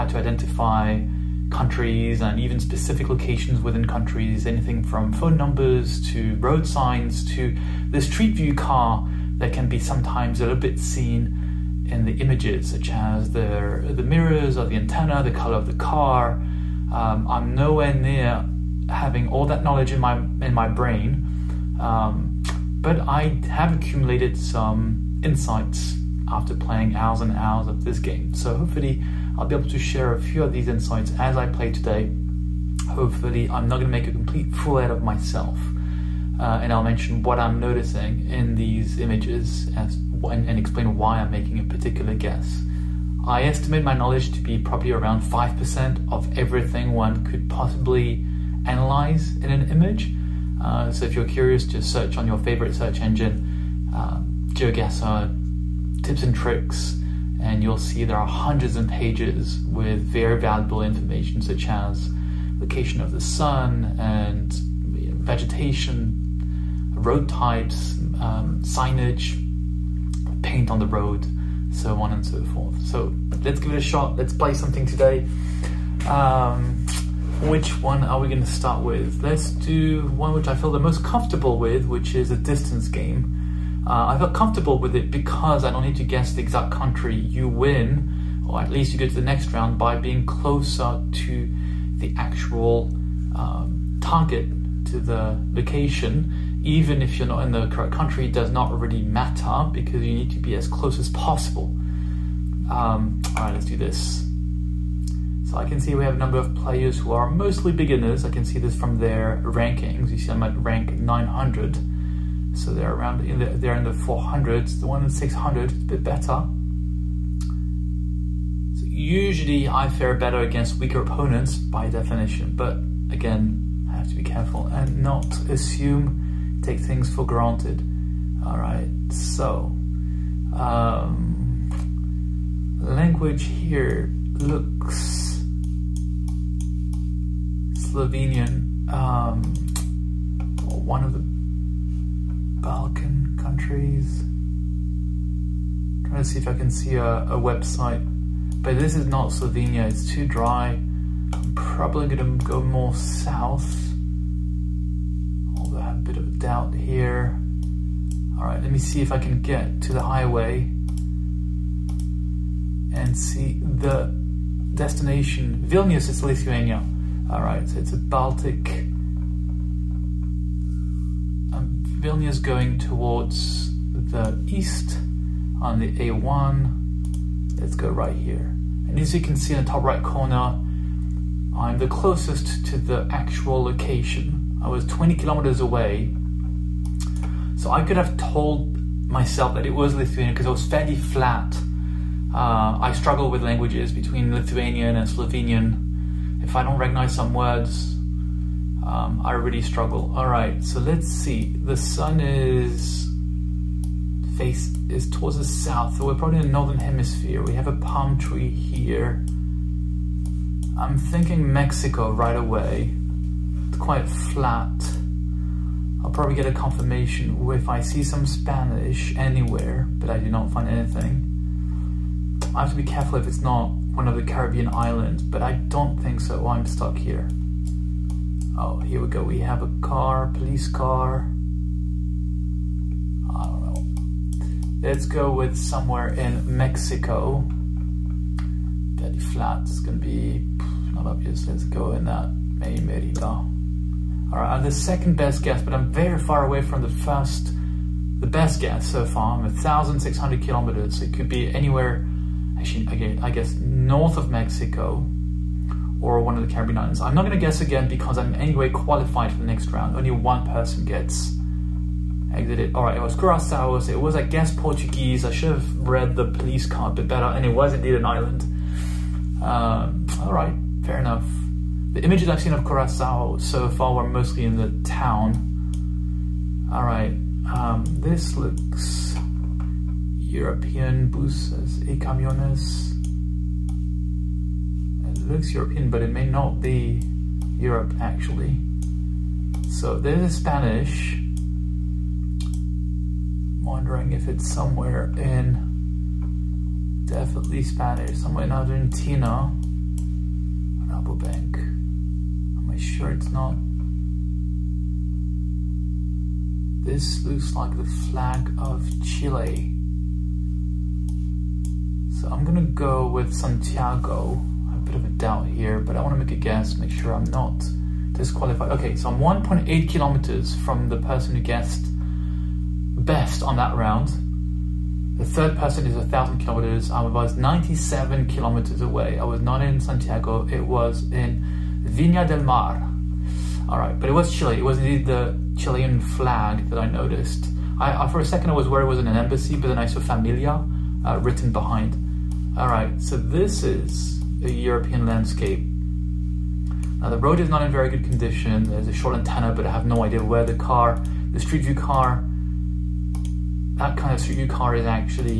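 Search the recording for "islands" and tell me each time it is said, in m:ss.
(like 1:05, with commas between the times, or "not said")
3:44, 4:16, 4:28.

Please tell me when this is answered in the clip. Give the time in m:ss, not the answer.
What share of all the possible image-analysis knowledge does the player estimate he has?
0:45.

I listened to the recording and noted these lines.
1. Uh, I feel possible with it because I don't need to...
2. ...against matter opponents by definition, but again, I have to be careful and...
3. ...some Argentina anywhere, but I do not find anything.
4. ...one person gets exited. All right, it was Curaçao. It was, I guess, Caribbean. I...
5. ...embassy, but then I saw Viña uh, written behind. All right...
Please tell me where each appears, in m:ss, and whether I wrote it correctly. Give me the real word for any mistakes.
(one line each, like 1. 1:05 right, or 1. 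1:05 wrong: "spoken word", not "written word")
1. 1:23 wrong: "comfortable", not "possible"
2. 2:00 wrong: "weaker", not "matter"
3. 3:38 wrong: "Spanish", not "Argentina"
4. 4:20 wrong: "Portuguese", not "Caribbean"
5. 5:39 wrong: "Familia", not "Viña".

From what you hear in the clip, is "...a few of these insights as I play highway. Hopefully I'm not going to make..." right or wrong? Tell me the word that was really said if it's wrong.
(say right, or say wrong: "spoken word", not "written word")
wrong: "today", not "highway".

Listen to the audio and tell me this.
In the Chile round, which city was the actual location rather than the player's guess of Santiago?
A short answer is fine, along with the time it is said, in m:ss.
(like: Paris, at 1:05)
Viña del Mar, at 5:31.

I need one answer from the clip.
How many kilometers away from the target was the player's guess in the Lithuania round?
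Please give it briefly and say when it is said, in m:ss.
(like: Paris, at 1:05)
20, at 3:04.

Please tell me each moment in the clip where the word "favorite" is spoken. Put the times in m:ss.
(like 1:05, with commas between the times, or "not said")
0:52.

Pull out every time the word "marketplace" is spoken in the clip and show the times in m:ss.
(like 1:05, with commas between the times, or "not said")
not said.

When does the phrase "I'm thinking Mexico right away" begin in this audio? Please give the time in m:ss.
3:30.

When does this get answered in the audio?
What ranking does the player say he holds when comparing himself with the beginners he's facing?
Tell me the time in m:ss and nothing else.
1:50.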